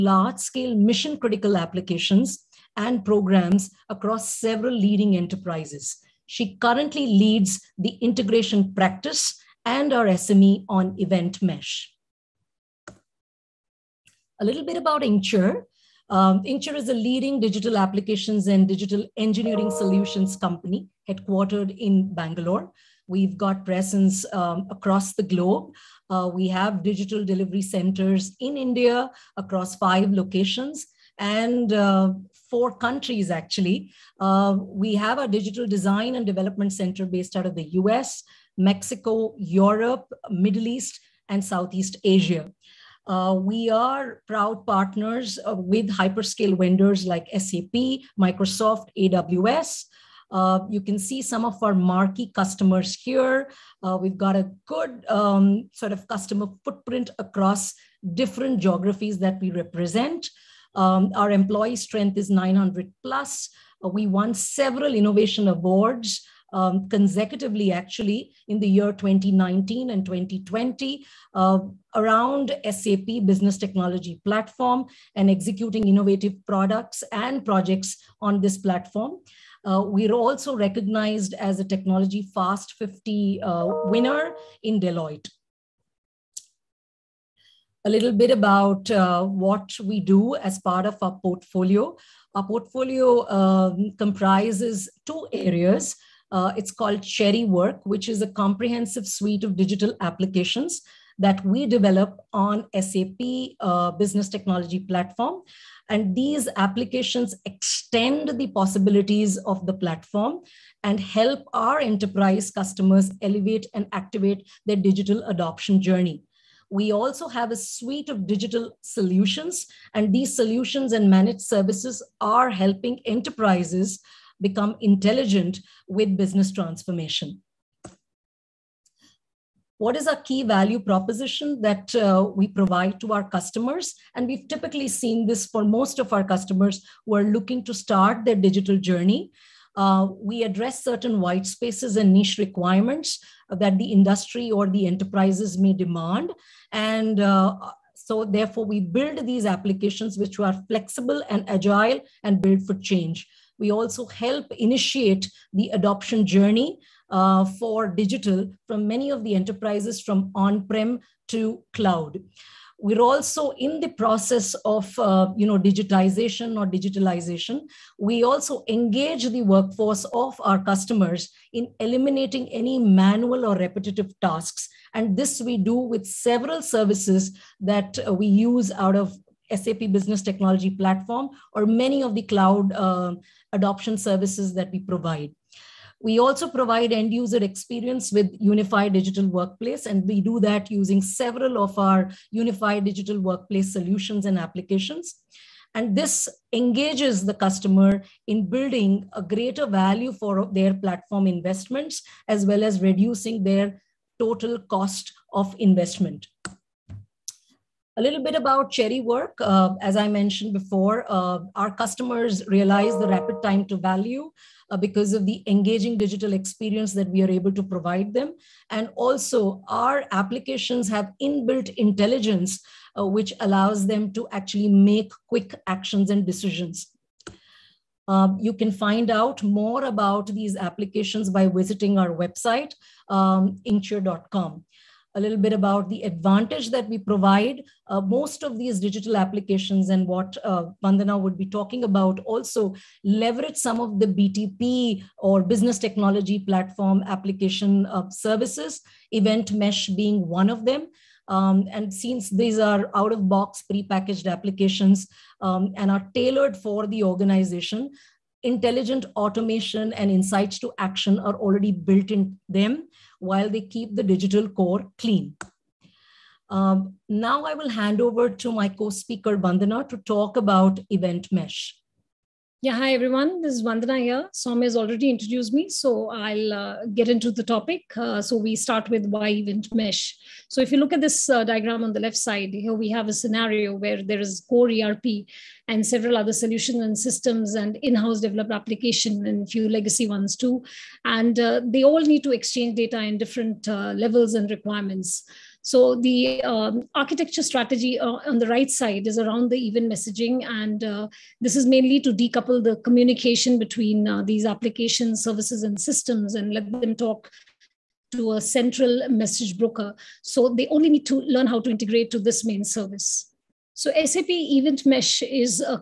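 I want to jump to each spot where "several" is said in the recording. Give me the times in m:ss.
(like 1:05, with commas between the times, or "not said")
0:04, 1:04, 2:56, 3:11, 4:45.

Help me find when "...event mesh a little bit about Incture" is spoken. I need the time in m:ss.
0:10.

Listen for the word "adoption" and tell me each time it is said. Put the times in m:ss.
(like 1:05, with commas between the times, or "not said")
1:55, 2:35, 3:03.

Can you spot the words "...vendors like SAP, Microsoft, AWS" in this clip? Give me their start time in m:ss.
0:46.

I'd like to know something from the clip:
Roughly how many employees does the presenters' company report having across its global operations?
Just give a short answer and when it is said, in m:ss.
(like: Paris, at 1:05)
900 plus, at 1:02.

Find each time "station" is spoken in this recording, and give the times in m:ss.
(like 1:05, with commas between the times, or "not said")
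not said.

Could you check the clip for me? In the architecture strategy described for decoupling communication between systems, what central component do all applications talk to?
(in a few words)
central message broker.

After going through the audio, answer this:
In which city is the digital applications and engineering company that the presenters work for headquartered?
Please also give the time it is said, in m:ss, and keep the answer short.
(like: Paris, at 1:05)
Bangalore, at 0:22.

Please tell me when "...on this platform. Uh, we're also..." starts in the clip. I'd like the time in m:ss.
1:18.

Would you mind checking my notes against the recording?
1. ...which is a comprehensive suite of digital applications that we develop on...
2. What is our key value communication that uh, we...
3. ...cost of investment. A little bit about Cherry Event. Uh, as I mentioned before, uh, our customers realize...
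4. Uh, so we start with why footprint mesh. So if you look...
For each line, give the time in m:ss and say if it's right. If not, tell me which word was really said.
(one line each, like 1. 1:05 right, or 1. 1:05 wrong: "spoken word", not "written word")
1. 1:37 right
2. 2:09 wrong: "proposition", not "communication"
3. 3:24 wrong: "Work", not "Event"
4. 4:37 wrong: "event", not "footprint".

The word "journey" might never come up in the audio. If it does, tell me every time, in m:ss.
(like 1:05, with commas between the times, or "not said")
1:55, 2:18, 2:36.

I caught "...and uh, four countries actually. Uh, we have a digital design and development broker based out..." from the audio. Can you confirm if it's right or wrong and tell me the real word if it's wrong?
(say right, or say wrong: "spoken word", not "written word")
wrong: "center", not "broker".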